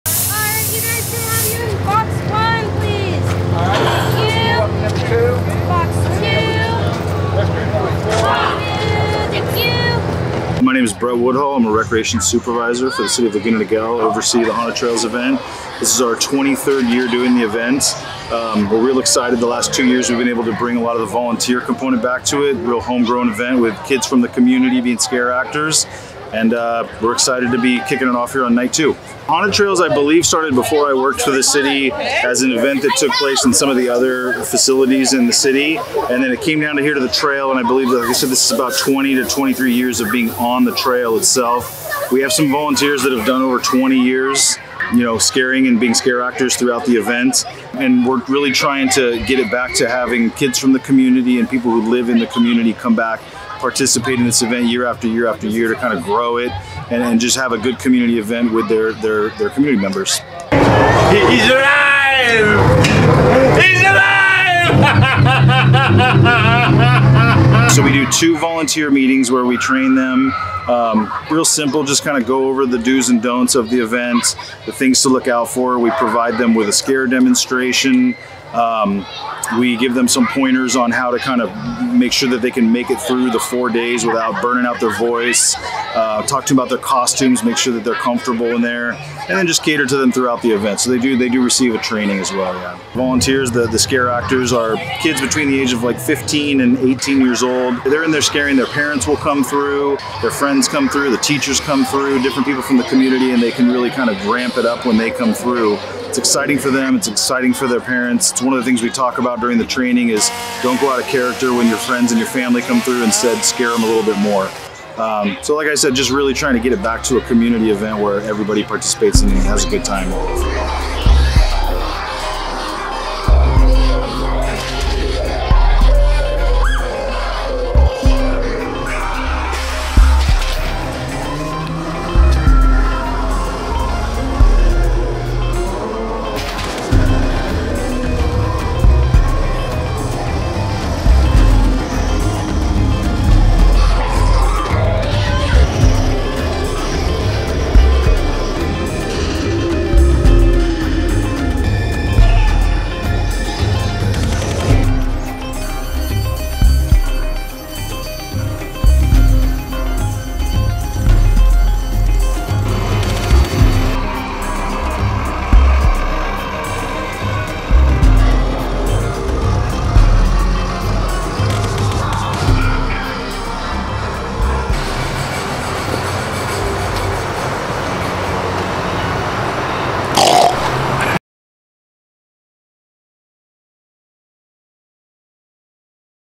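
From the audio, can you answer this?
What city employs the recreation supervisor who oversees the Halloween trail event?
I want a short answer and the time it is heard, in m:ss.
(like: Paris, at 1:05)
Laguna Niguel, at 0:13.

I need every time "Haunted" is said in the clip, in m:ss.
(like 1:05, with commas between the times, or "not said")
0:14, 0:29.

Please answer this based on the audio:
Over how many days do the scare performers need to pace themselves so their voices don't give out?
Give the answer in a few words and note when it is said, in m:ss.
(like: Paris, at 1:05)
4, at 1:23.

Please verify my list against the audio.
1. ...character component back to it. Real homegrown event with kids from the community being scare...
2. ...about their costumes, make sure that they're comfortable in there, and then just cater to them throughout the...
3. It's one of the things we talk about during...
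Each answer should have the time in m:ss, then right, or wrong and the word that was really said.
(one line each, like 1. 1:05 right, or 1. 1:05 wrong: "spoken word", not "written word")
1. 0:21 wrong: "volunteer", not "character"
2. 1:26 right
3. 1:48 right.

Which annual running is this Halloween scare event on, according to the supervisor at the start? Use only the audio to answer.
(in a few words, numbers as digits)
23rd.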